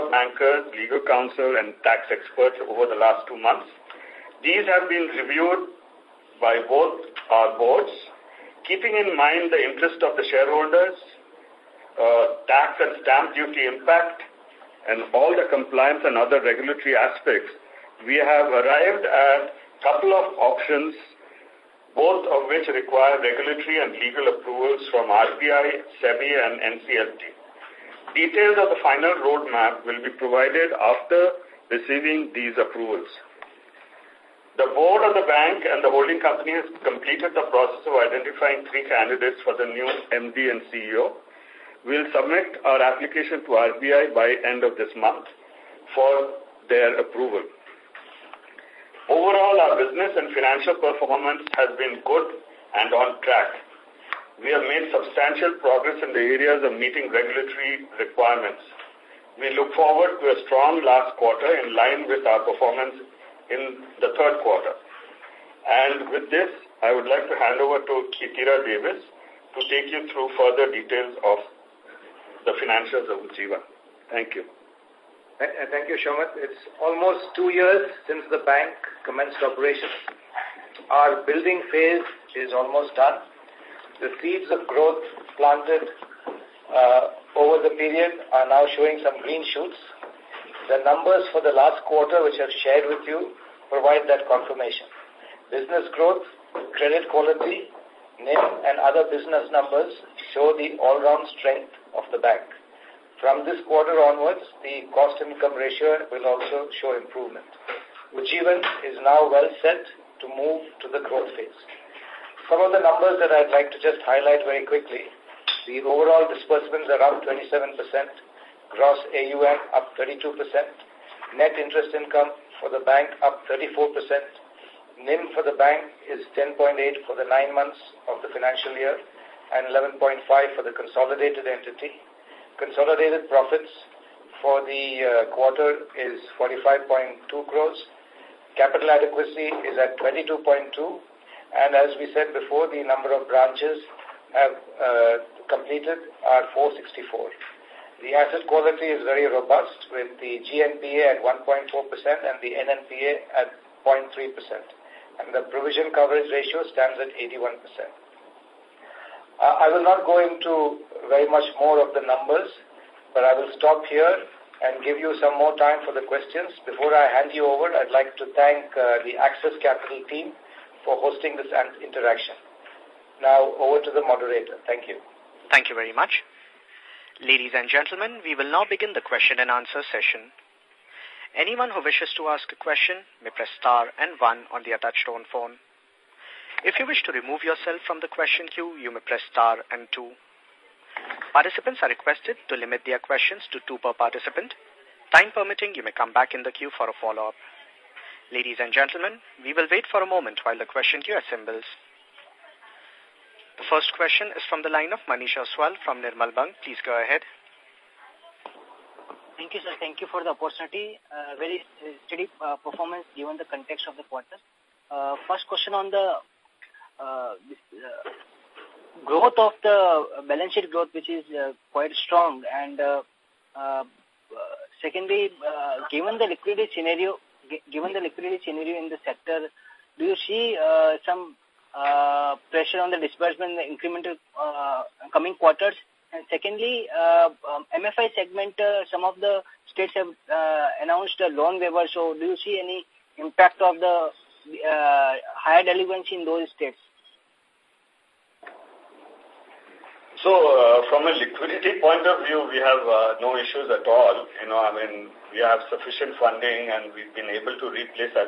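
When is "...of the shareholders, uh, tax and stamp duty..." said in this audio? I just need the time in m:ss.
0:10.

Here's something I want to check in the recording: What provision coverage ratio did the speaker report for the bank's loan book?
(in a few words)
81%.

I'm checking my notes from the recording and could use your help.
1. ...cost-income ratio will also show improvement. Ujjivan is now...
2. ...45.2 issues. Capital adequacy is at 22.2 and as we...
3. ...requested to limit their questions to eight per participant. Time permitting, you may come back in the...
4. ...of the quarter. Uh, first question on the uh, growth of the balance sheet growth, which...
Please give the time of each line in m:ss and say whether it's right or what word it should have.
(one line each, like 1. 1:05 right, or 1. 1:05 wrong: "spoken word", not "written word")
1. 1:44 right
2. 2:16 wrong: "crores", not "issues"
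3. 3:11 wrong: "two", not "eight"
4. 3:33 right.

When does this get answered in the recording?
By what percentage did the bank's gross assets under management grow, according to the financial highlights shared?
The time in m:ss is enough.
1:58.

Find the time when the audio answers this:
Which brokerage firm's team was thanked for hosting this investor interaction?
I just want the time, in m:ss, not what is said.
2:49.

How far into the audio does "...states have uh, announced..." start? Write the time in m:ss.
3:59.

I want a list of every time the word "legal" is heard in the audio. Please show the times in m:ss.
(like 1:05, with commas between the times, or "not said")
0:00, 0:23.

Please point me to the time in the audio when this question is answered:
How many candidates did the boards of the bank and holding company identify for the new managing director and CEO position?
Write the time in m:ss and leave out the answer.
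0:38.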